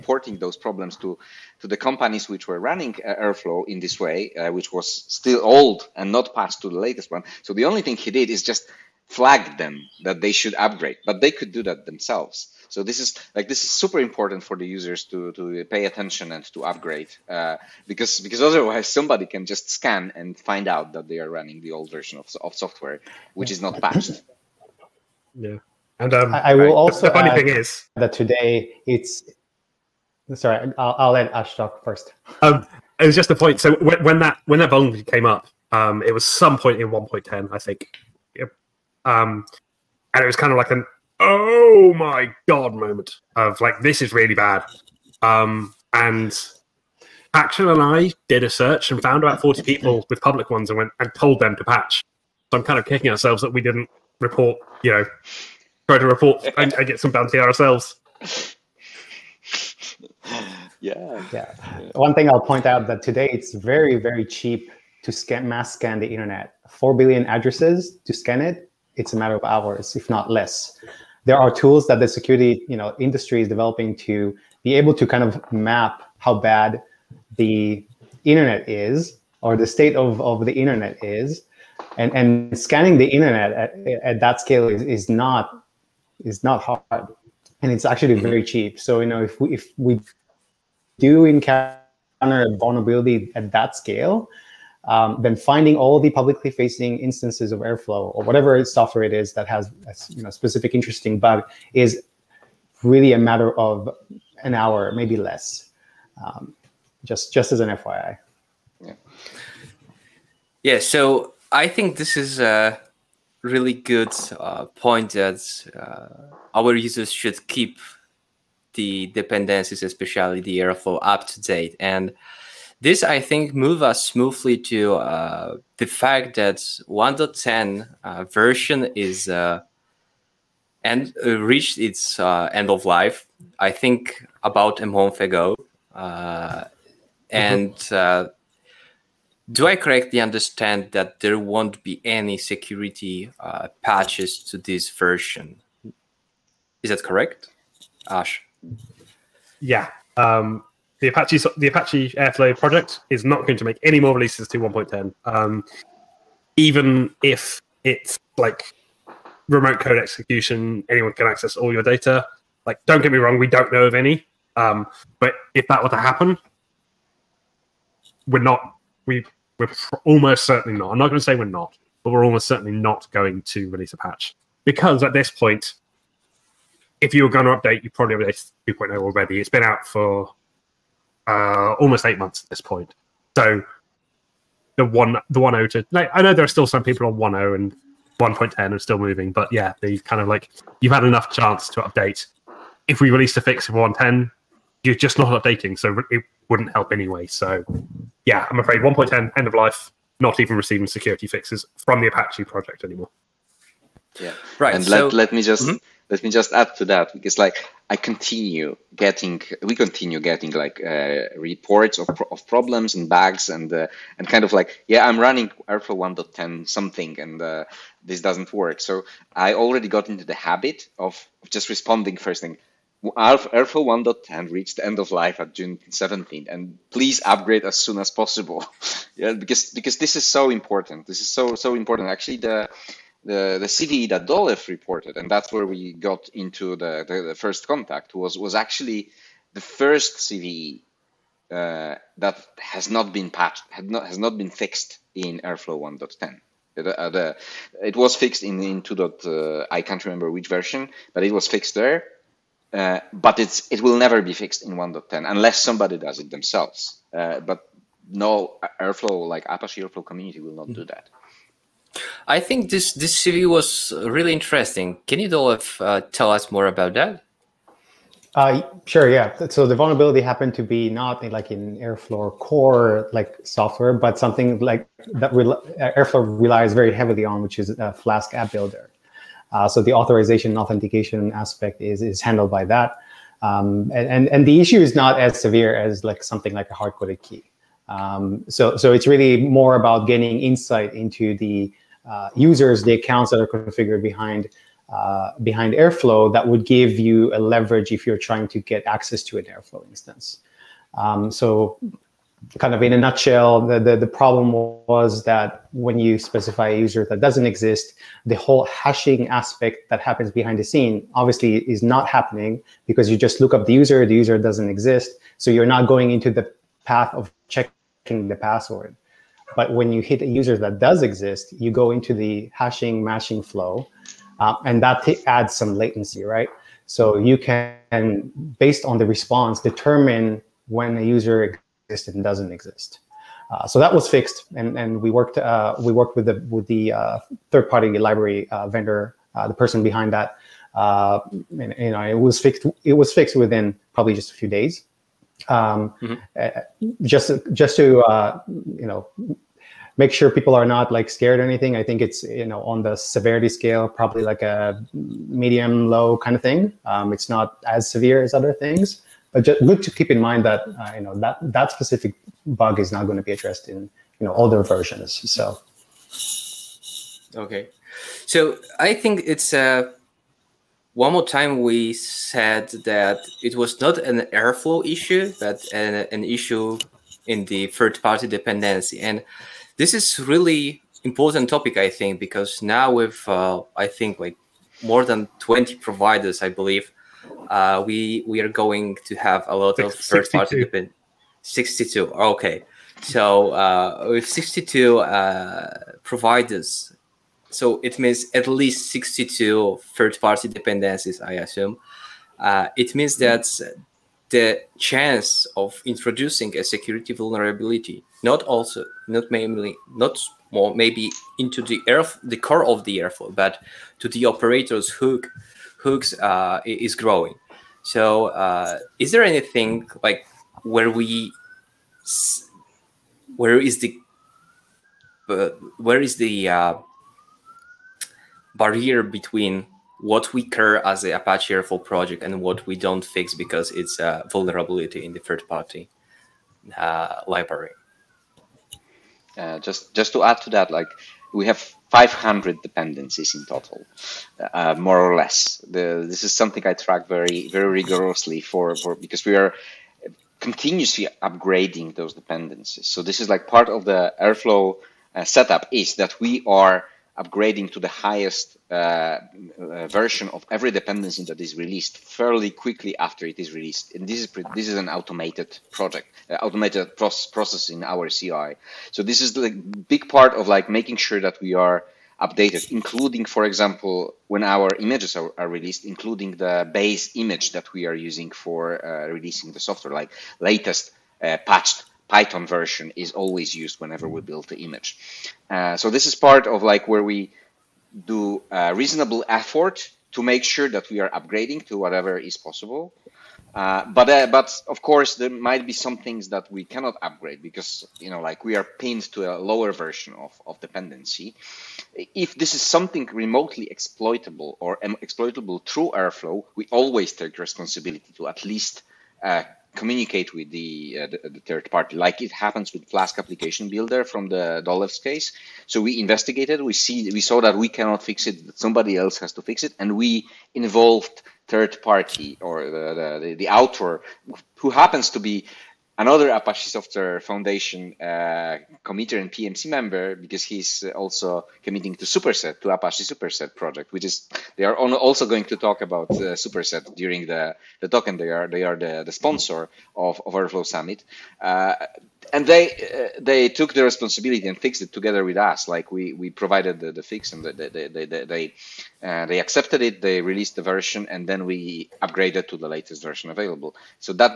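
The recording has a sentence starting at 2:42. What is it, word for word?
Like, don't get me wrong, we don't know of any.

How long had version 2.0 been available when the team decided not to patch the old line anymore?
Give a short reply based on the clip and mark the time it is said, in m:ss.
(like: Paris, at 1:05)
almost 8 months, at 3:01.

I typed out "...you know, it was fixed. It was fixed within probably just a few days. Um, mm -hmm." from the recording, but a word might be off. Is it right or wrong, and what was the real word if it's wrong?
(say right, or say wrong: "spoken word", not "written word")
right.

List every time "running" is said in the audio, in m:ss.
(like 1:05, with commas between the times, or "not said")
0:02, 0:21, 3:35.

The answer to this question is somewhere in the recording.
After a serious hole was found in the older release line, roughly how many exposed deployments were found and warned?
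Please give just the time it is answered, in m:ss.
0:49.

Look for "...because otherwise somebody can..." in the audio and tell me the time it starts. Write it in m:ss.
0:18.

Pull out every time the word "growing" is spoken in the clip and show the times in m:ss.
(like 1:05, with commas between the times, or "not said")
6:56.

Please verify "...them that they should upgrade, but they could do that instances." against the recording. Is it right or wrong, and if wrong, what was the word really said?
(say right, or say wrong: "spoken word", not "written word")
wrong: "themselves", not "instances".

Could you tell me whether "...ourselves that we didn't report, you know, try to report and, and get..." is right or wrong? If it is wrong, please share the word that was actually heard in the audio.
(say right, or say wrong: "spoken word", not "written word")
right.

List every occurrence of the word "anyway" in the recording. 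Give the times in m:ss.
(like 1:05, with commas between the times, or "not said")
3:16.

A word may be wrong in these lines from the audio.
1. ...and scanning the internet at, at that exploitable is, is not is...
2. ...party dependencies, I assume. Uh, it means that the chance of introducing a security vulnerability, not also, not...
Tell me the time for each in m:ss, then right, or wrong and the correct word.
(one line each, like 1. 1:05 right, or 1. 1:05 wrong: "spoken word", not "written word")
1. 1:22 wrong: "scale", not "exploitable"
2. 6:40 right.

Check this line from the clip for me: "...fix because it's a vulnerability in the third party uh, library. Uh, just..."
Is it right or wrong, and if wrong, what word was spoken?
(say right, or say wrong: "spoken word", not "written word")
right.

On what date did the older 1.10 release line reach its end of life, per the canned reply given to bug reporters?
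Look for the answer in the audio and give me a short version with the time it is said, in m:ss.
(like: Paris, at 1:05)
June 17th, at 3:45.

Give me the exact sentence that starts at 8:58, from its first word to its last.
They are they are the, the sponsor of, of Airflow Summit.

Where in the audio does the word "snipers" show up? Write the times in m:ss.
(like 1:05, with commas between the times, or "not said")
not said.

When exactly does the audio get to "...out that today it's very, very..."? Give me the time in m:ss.
1:02.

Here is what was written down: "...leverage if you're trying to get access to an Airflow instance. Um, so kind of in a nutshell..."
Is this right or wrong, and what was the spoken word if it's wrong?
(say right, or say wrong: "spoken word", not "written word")
right.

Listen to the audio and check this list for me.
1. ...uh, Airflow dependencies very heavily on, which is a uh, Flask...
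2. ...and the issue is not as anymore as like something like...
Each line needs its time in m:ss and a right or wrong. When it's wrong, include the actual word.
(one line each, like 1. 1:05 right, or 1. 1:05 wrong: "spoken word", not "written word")
1. 4:35 wrong: "relies", not "dependencies"
2. 4:44 wrong: "severe", not "anymore".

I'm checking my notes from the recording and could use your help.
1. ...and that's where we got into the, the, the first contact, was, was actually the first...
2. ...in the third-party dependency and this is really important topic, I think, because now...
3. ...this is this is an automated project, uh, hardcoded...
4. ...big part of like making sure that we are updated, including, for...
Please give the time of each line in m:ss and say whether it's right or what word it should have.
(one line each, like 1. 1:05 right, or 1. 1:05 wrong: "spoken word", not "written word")
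1. 3:55 right
2. 6:17 right
3. 7:44 wrong: "automated", not "hardcoded"
4. 7:49 right.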